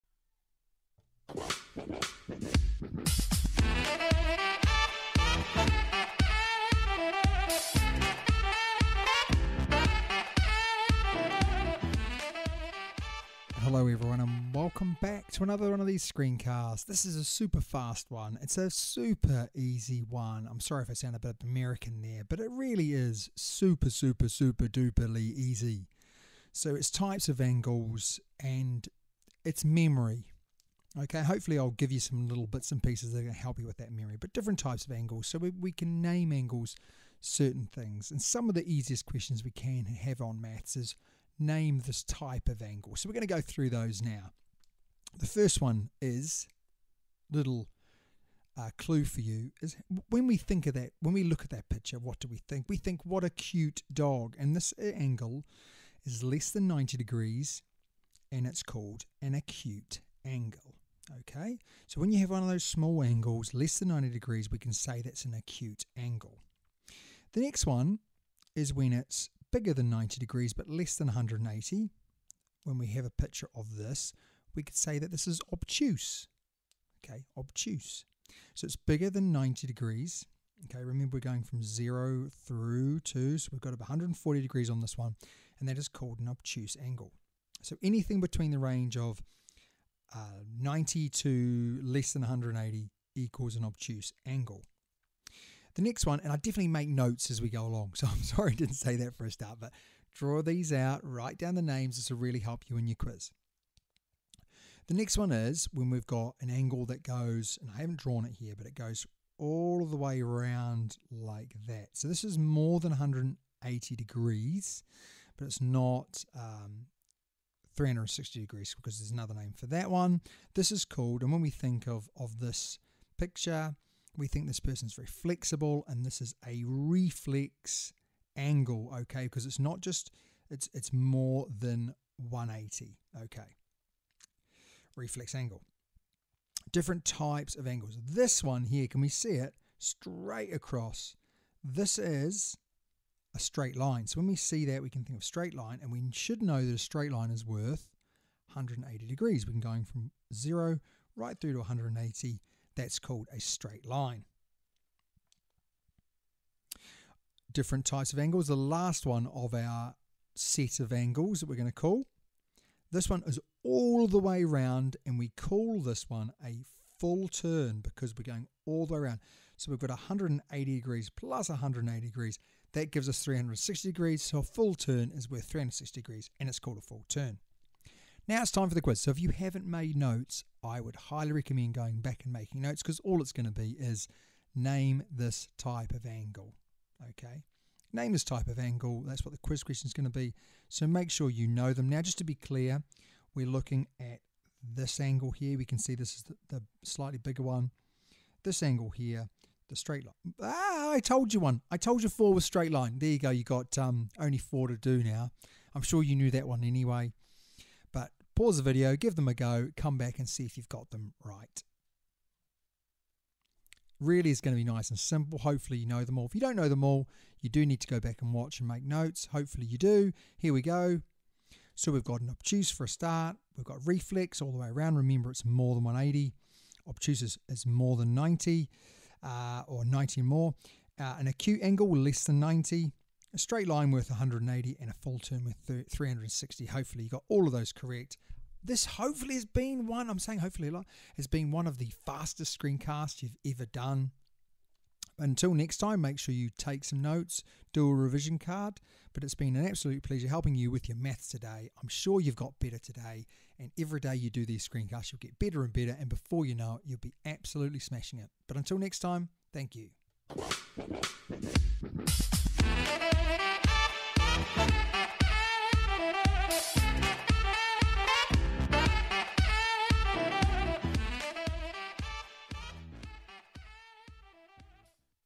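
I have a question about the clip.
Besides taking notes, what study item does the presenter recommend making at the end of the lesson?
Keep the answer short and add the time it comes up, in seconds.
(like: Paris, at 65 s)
a revision card, at 247 s.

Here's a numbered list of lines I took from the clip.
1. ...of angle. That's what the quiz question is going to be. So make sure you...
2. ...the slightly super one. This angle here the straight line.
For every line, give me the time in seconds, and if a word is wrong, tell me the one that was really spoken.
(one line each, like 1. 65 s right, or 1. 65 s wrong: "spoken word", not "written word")
1. 188 s right
2. 196 s wrong: "bigger", not "super".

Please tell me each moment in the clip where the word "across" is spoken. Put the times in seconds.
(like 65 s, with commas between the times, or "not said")
140 s.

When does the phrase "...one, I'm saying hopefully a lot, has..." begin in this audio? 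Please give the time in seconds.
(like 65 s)
239 s.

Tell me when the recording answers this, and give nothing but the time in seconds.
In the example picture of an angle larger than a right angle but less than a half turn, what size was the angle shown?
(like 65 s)
83 s.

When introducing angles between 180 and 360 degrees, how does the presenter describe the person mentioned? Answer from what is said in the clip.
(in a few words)
very flexible.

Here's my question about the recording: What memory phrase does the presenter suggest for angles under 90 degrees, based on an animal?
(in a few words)
What a cute dog.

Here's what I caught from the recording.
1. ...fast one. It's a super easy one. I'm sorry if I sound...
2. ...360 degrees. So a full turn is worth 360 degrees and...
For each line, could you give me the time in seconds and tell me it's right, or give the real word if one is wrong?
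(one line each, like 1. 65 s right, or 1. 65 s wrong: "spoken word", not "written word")
1. 17 s right
2. 173 s right.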